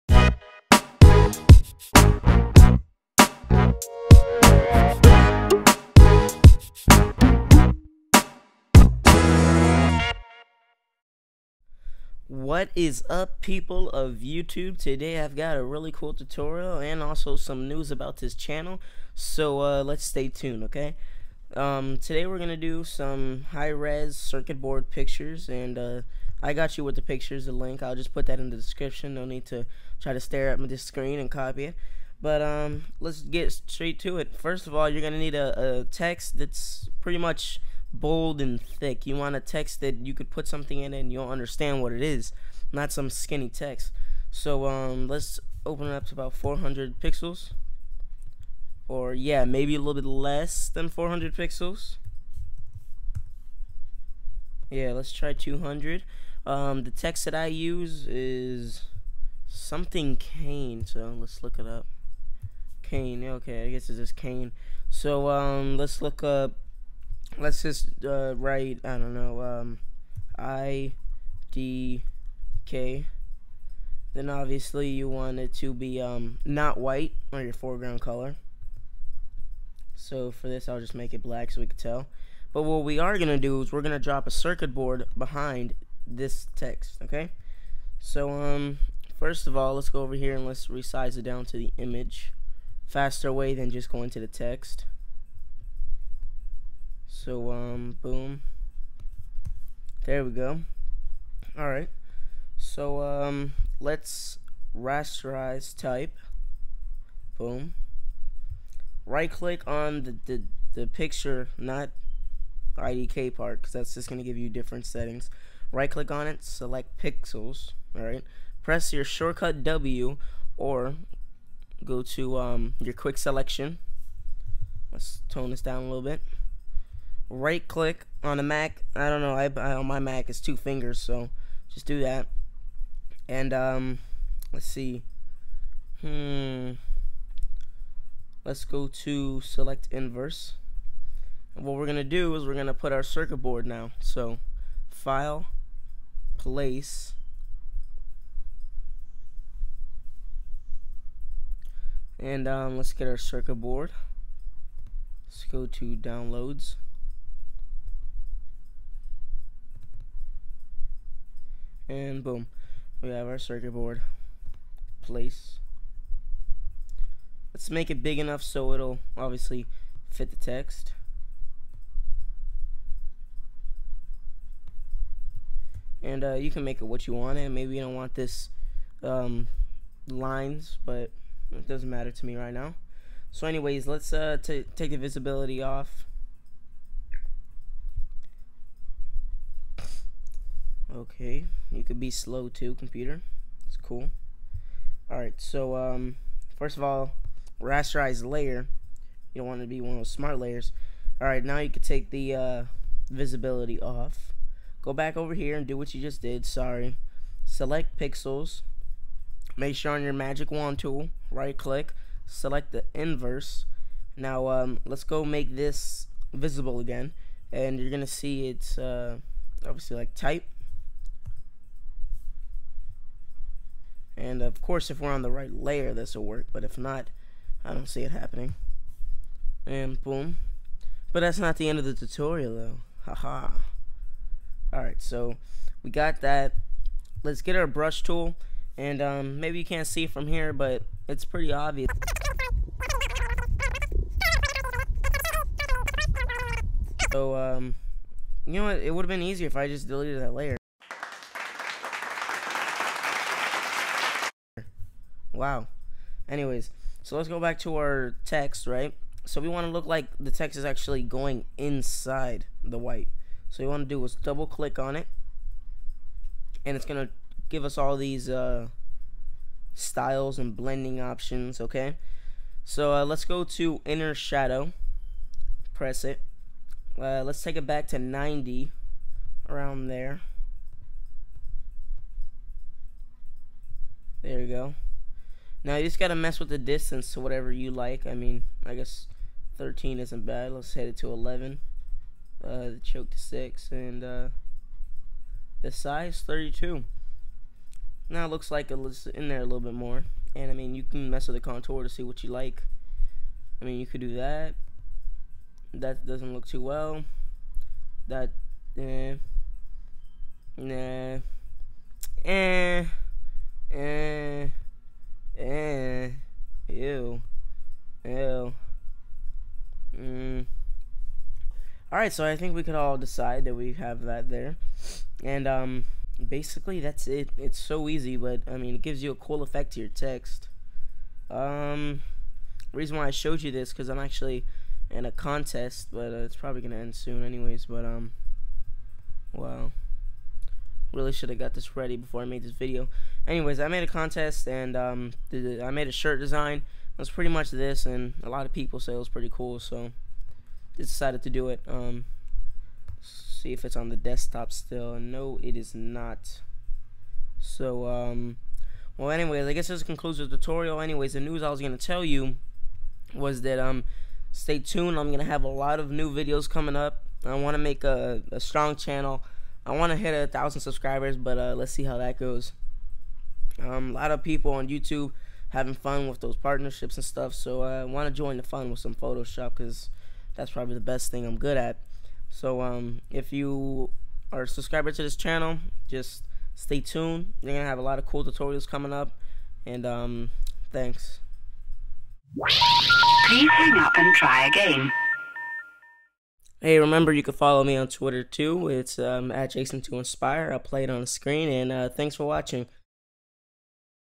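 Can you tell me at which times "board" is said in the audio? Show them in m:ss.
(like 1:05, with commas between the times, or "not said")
0:24, 1:24, 2:23, 2:33, 2:43.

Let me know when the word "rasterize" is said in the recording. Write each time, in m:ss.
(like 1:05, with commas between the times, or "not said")
1:44, 3:17.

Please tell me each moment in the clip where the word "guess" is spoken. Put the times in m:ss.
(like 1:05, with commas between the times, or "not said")
1:03, 4:48, 5:59.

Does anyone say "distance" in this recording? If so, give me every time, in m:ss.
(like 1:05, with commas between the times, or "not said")
4:46.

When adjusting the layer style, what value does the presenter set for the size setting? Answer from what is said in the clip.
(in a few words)
32.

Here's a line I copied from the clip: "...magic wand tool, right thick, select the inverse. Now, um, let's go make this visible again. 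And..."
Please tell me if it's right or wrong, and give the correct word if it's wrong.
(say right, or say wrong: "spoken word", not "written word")
wrong: "click", not "thick".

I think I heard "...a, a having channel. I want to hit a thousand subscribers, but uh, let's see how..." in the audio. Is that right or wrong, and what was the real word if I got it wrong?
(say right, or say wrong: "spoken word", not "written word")
wrong: "strong", not "having".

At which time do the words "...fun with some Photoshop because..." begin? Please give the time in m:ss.
6:18.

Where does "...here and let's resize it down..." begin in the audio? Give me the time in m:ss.
1:30.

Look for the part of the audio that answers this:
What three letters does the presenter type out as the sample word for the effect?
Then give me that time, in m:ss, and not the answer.
1:10.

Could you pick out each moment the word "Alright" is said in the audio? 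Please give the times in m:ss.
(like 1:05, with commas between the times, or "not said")
1:41, 1:57, 3:15, 3:21, 3:54, 5:21.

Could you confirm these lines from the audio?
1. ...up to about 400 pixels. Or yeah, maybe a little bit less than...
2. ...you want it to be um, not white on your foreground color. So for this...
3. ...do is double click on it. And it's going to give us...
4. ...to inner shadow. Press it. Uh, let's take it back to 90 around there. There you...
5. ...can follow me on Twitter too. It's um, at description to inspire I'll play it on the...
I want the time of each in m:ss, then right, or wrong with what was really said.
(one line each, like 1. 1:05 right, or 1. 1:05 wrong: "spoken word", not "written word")
1. 0:45 right
2. 1:14 right
3. 4:23 right
4. 4:33 right
5. 6:37 wrong: "jason", not "description".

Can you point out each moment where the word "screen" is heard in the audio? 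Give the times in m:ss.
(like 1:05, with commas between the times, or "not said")
0:30, 6:41.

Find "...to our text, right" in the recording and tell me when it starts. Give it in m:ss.
4:17.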